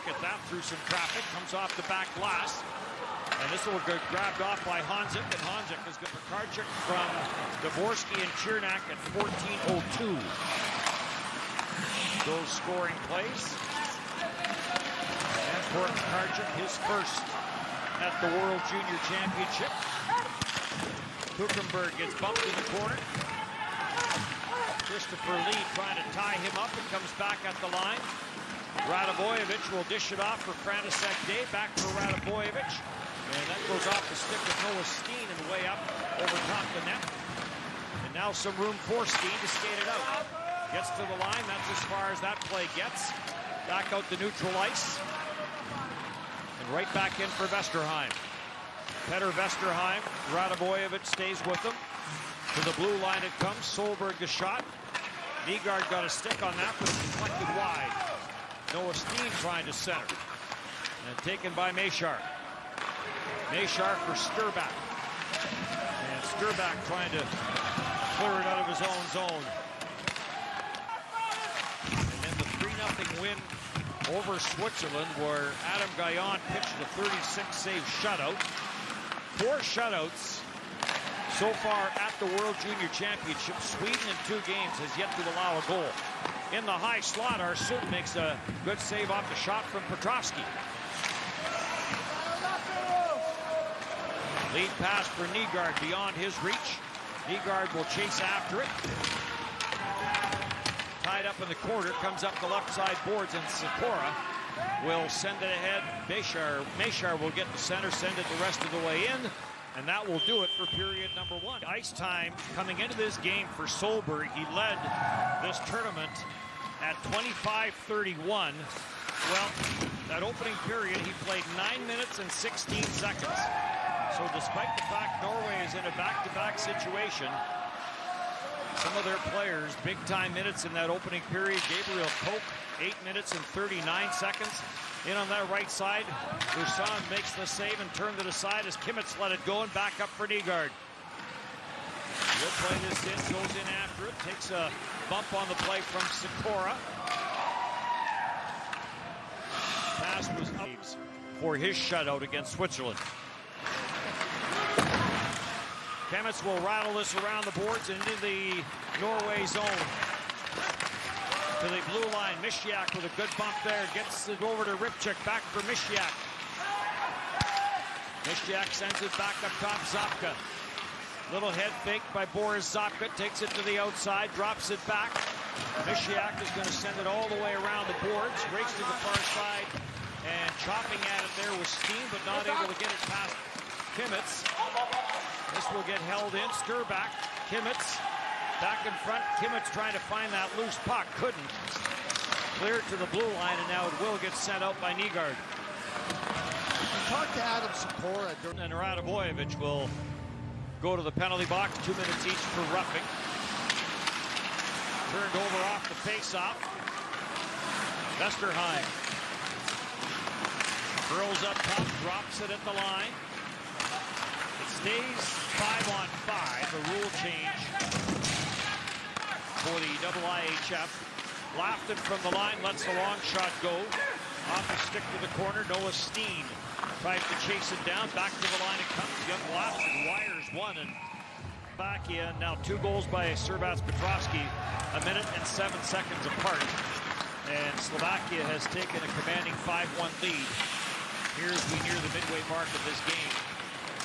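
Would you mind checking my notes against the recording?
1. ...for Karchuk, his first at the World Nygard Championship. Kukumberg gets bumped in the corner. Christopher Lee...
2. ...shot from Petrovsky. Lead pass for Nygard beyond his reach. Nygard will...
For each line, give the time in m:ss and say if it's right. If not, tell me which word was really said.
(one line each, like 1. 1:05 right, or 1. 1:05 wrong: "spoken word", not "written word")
1. 0:15 wrong: "Junior", not "Nygard"
2. 1:29 right.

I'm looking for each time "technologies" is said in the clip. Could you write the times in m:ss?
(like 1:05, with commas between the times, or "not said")
not said.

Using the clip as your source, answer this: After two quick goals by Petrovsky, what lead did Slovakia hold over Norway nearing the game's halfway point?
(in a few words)
5-1.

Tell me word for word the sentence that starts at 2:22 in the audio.
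Will play this in, goes in after it, takes a bump on the play from Sikora.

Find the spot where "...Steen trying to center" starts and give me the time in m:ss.
0:58.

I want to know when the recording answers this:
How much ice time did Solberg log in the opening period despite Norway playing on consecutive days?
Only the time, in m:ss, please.
2:01.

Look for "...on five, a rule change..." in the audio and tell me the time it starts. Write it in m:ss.
3:35.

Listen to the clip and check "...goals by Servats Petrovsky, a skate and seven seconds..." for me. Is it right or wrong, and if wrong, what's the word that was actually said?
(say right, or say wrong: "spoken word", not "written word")
wrong: "minute", not "skate".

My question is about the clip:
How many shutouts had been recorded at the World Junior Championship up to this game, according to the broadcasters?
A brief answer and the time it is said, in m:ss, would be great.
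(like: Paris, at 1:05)
4, at 1:19.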